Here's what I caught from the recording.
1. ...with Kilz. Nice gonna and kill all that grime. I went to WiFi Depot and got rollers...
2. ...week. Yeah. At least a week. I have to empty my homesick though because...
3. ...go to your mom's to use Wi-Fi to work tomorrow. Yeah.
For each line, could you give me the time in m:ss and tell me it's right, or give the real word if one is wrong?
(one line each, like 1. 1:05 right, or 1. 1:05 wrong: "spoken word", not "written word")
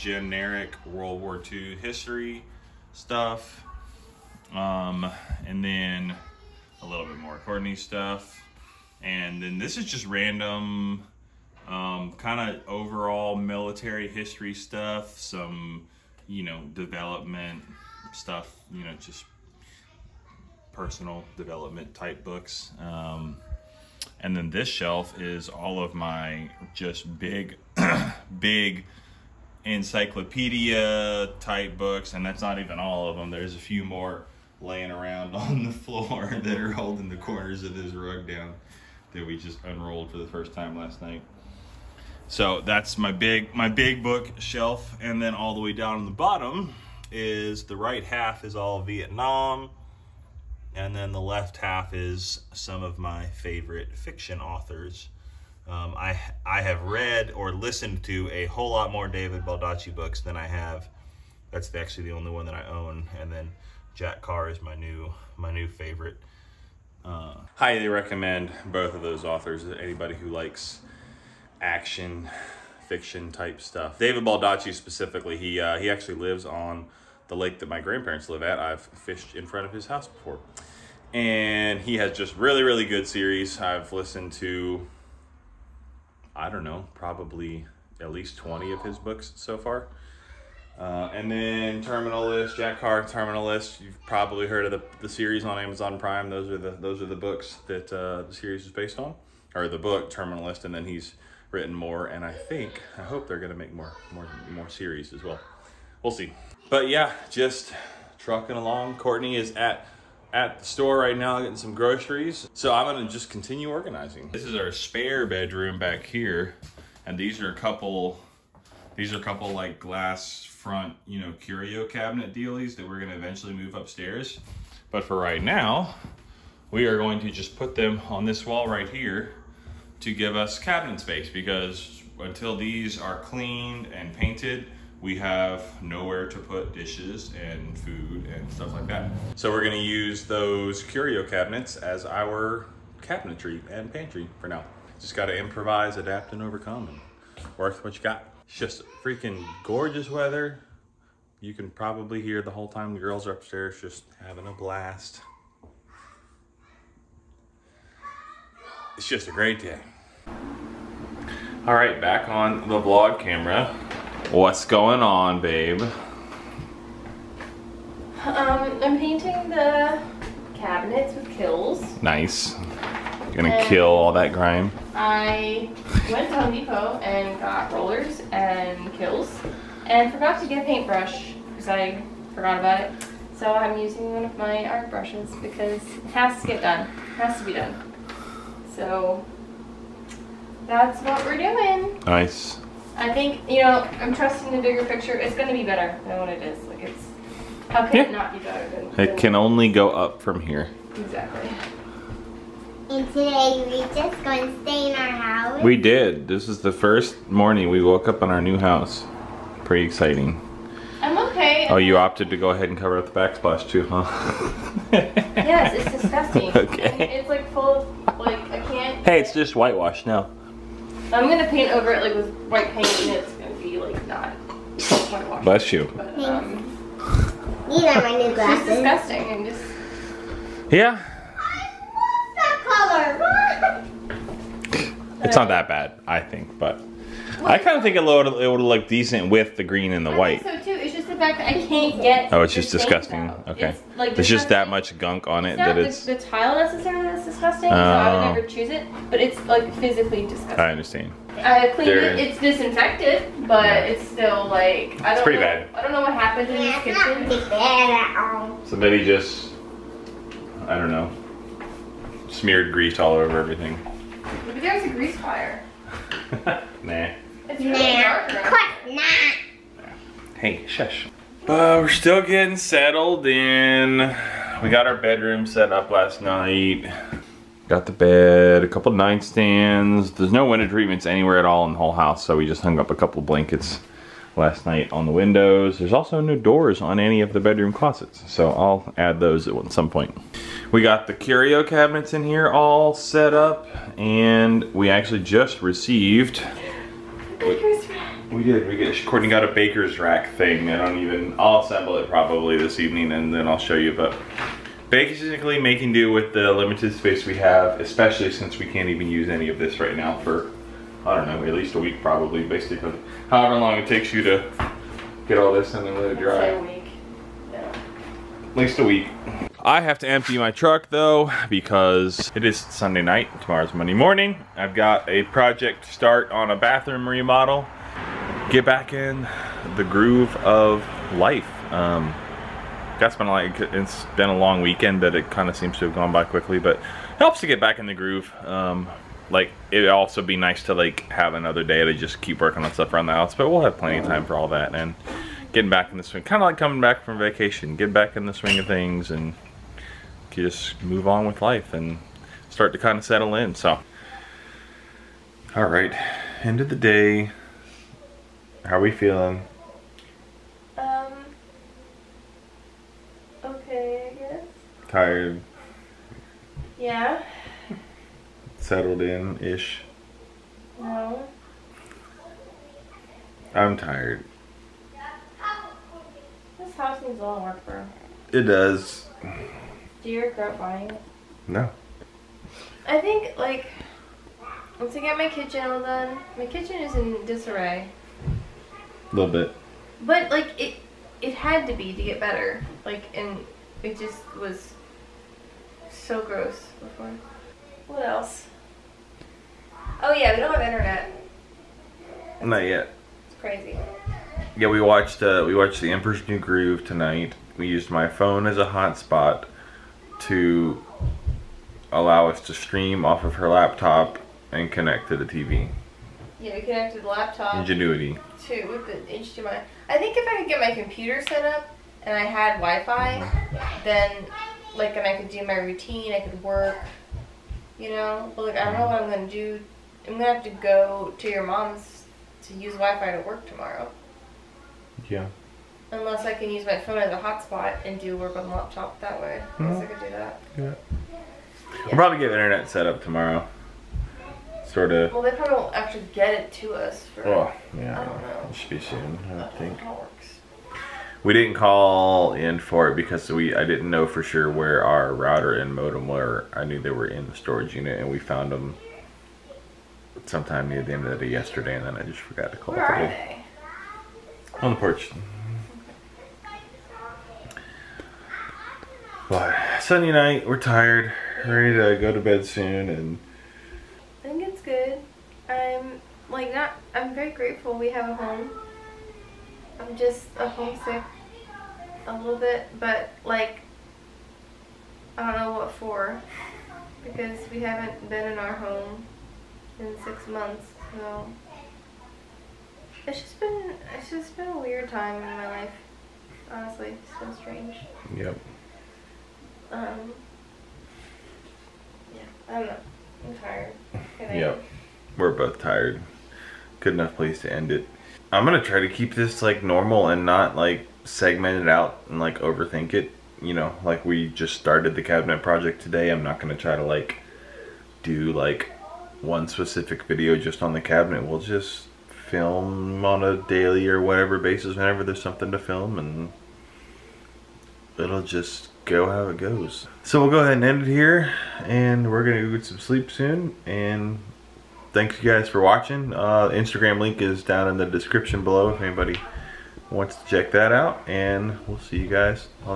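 1. 2:51 wrong: "Home", not "WiFi"
2. 5:16 wrong: "truck", not "homesick"
3. 7:10 right.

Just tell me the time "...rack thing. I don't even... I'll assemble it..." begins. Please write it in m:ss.
4:59.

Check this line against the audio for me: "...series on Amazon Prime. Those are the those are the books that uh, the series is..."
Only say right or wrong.
right.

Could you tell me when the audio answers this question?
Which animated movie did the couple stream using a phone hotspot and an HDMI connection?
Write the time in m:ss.
6:45.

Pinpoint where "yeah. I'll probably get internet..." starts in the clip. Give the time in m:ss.
7:20.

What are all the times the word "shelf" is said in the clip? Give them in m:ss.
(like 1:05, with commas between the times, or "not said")
0:24, 0:44.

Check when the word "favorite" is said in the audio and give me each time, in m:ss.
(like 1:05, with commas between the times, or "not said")
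0:53, 1:05.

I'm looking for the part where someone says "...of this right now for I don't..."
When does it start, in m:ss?
5:09.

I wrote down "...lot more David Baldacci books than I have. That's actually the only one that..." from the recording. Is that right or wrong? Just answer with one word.
right.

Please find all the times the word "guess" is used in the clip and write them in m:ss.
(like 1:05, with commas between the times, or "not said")
6:04, 7:19.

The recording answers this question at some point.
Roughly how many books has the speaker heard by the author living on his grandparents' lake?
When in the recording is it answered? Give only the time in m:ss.
1:28.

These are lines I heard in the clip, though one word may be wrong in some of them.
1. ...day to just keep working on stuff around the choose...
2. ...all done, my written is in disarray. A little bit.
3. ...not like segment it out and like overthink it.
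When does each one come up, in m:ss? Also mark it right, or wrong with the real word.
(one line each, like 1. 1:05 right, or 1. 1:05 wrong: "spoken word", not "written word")
1. 5:41 wrong: "house", not "choose"
2. 6:25 wrong: "kitchen", not "written"
3. 8:30 right.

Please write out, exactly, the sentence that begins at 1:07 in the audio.
Uh, highly recommend both of those authors.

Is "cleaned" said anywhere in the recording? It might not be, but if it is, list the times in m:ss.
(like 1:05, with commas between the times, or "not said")
2:13, 4:11.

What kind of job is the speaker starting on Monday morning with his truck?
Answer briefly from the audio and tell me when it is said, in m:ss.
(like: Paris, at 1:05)
bathroom remodel, at 5:26.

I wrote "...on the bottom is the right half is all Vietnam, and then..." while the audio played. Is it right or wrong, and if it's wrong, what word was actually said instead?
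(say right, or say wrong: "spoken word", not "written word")
right.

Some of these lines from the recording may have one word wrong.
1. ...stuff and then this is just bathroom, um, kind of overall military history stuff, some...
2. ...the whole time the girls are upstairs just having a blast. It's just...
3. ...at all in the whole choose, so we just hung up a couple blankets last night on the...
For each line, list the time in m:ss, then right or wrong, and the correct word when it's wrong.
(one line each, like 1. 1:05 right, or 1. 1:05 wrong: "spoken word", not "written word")
1. 0:07 wrong: "random", not "bathroom"
2. 2:32 right
3. 4:41 wrong: "house", not "choose".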